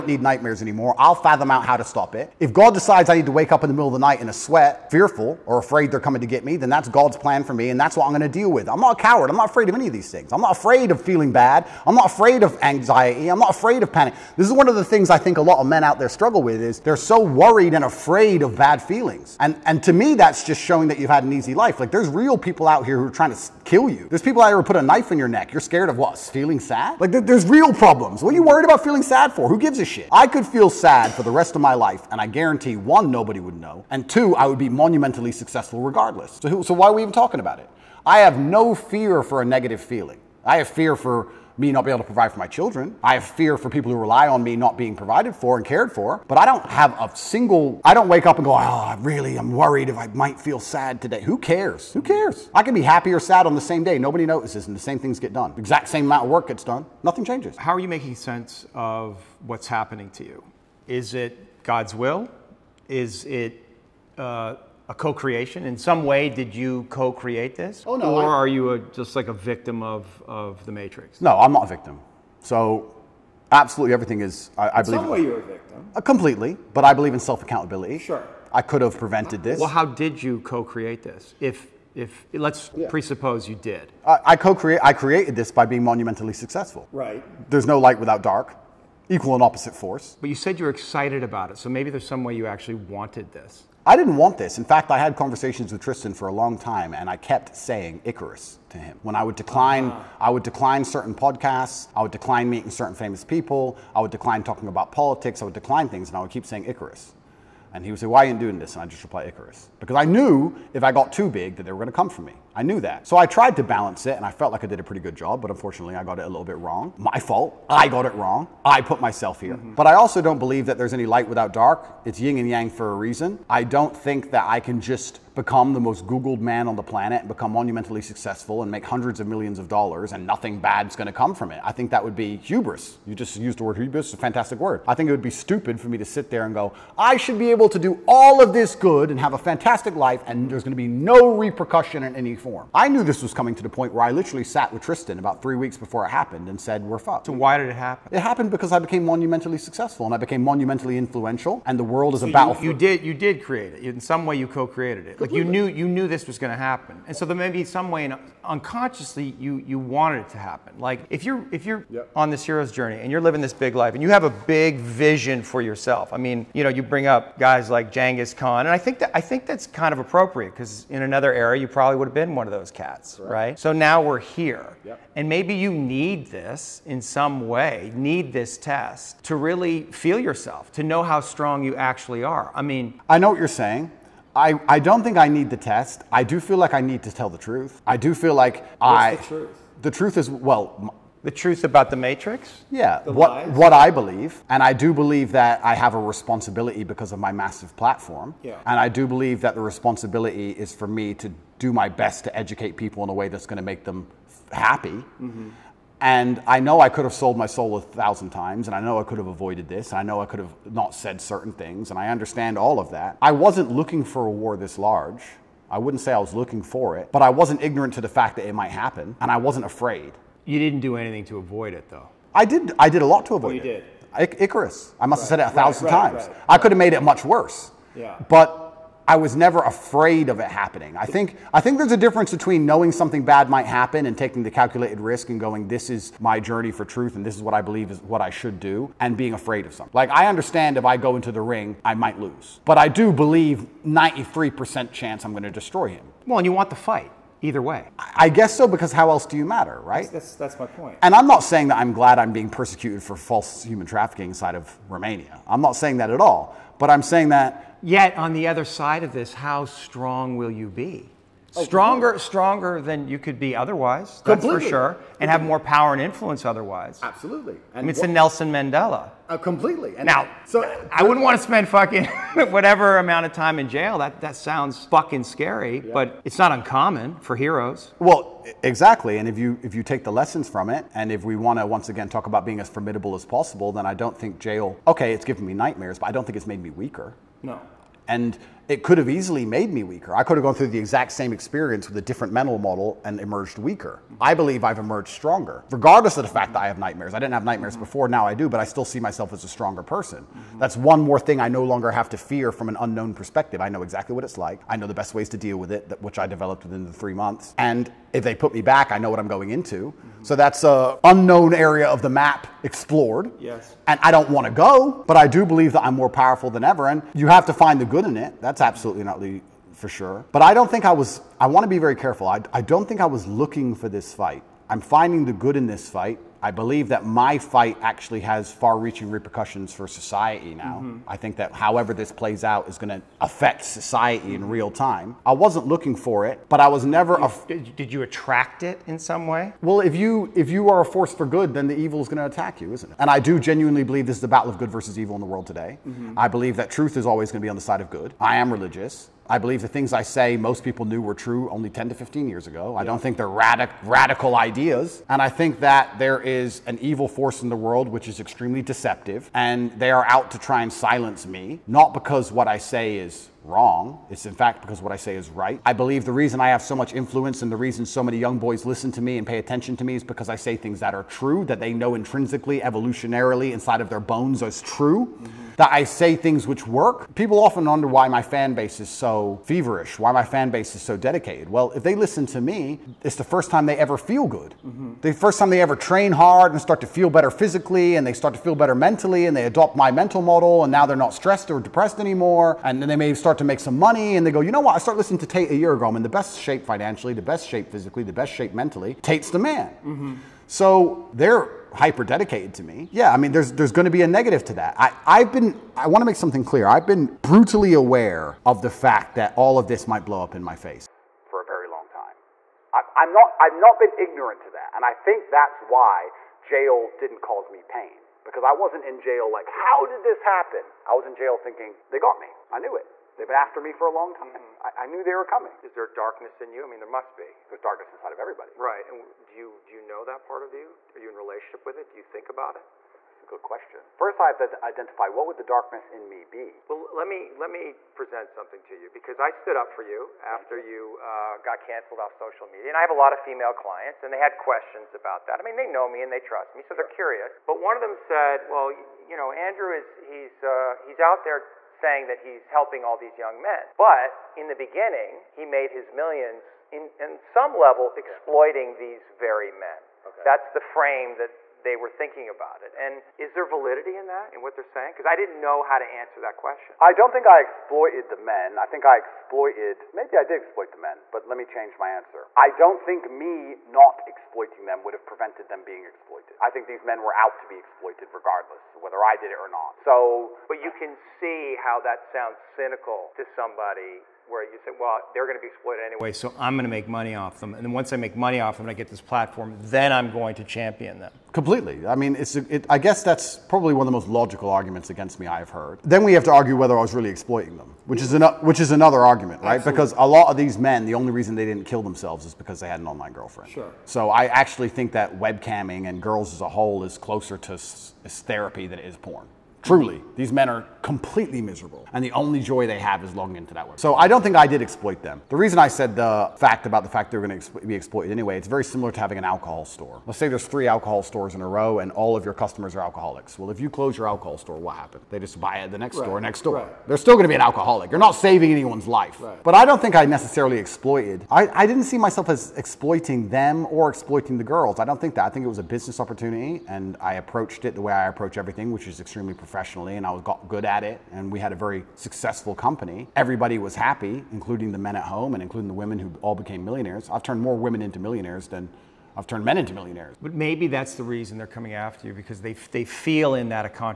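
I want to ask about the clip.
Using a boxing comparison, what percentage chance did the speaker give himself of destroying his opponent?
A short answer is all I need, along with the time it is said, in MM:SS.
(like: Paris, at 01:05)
93%, at 04:03.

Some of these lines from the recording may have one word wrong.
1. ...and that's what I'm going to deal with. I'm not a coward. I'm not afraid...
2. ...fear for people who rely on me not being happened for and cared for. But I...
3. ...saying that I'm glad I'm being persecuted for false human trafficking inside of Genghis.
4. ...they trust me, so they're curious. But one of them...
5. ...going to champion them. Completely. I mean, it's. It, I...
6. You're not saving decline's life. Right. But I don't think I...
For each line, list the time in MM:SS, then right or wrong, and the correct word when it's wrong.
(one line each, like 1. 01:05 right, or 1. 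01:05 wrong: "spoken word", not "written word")
1. 00:07 right
2. 00:43 wrong: "provided", not "happened"
3. 04:11 wrong: "Romania", not "Genghis"
4. 07:26 right
5. 08:10 right
6. 08:47 wrong: "anyone", not "decline".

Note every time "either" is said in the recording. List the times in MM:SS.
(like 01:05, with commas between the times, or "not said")
04:07.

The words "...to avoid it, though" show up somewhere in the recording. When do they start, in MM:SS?
03:41.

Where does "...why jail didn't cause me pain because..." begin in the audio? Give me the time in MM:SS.
06:55.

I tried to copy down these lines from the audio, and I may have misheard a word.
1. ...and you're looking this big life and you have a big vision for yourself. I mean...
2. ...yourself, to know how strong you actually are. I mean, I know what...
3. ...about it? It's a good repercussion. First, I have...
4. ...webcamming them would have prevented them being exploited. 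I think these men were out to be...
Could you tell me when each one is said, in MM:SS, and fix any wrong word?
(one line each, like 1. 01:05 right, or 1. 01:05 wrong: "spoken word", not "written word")
1. 02:42 wrong: "living", not "looking"
2. 03:00 right
3. 07:12 wrong: "question", not "repercussion"
4. 07:54 wrong: "exploiting", not "webcamming".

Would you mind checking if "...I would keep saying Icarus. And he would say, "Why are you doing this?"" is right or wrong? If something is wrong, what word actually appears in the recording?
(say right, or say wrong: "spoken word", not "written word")
right.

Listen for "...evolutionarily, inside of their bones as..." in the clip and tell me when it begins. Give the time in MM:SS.
06:12.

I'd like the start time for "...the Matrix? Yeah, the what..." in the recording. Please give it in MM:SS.
03:11.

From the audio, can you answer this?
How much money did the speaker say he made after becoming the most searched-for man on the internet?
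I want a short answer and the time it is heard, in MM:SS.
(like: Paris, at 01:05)
hundreds of millions of dollars, at 02:08.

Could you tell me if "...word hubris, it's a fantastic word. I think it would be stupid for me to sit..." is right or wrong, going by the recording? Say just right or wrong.
right.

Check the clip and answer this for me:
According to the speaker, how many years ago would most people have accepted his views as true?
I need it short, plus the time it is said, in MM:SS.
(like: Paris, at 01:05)
10 to 15 years, at 05:51.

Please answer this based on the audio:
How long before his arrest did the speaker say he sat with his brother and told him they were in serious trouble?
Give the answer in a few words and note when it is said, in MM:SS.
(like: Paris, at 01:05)
three weeks, at 02:25.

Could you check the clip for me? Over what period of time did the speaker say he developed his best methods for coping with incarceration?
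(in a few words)
three months.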